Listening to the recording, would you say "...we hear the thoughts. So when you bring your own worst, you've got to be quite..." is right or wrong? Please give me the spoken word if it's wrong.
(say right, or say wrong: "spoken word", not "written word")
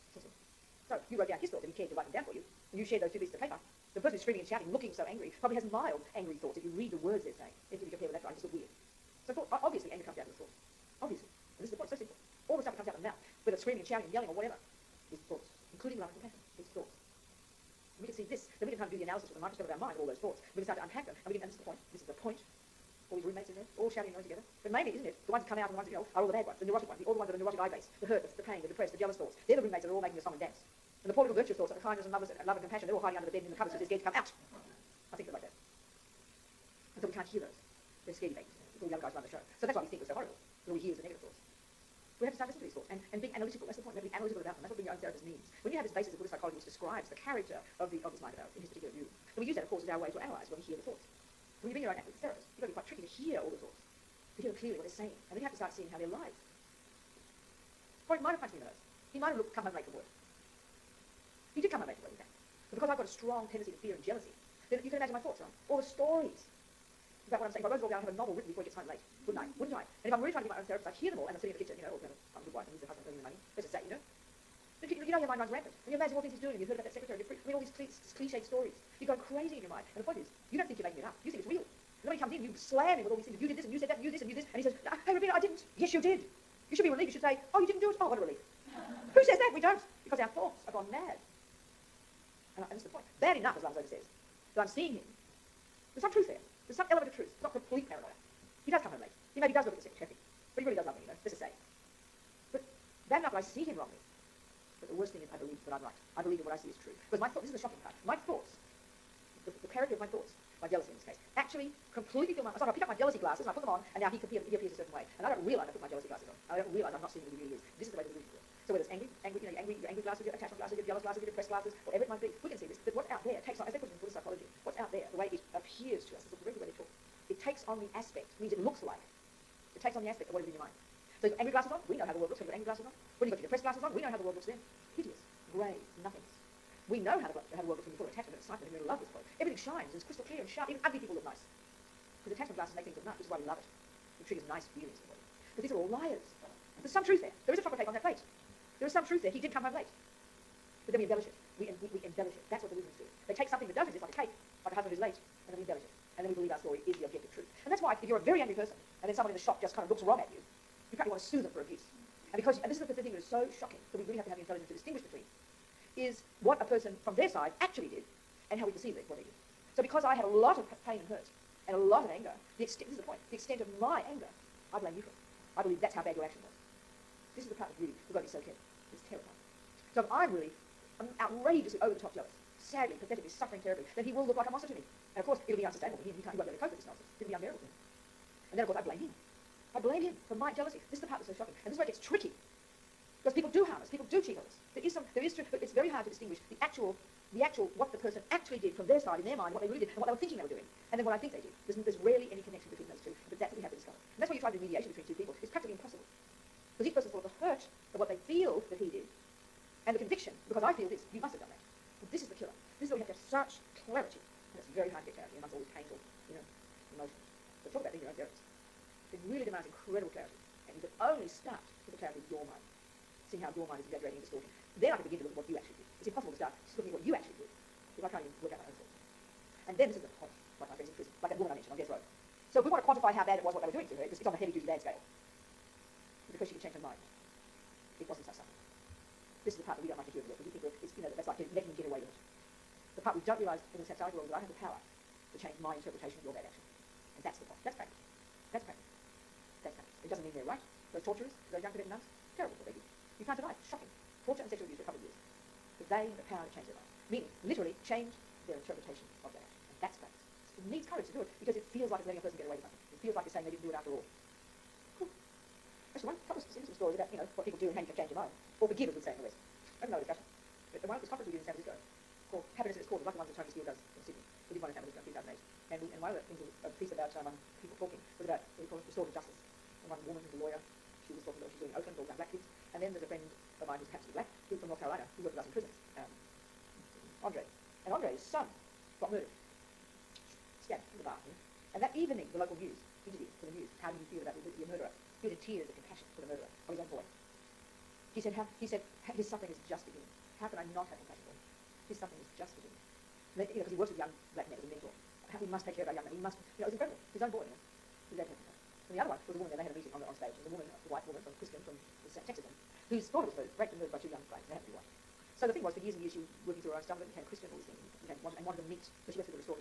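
wrong: "therapist", not "worst".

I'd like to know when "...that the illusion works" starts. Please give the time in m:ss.
1:58.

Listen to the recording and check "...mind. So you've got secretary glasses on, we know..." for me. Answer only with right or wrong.
wrong.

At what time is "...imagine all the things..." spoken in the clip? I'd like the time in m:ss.
1:15.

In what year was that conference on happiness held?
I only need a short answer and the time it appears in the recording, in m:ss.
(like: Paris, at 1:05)
2008, at 4:35.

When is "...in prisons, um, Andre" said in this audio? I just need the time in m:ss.
4:45.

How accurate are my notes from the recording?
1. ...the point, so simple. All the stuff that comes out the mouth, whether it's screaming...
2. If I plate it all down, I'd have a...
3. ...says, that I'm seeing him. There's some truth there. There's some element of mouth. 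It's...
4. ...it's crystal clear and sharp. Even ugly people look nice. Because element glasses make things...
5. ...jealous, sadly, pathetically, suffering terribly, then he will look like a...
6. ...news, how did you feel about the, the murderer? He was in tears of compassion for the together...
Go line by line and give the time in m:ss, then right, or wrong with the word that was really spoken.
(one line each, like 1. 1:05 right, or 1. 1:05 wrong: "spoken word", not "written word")
1. 0:11 right
2. 1:07 wrong: "wrote", not "plate"
3. 1:33 wrong: "truth", not "mouth"
4. 2:19 wrong: "attachment", not "element"
5. 3:02 right
6. 4:53 wrong: "murderer", not "together".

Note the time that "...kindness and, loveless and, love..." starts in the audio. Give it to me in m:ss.
0:31.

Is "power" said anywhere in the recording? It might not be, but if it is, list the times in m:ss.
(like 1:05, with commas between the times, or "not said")
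4:04, 4:16.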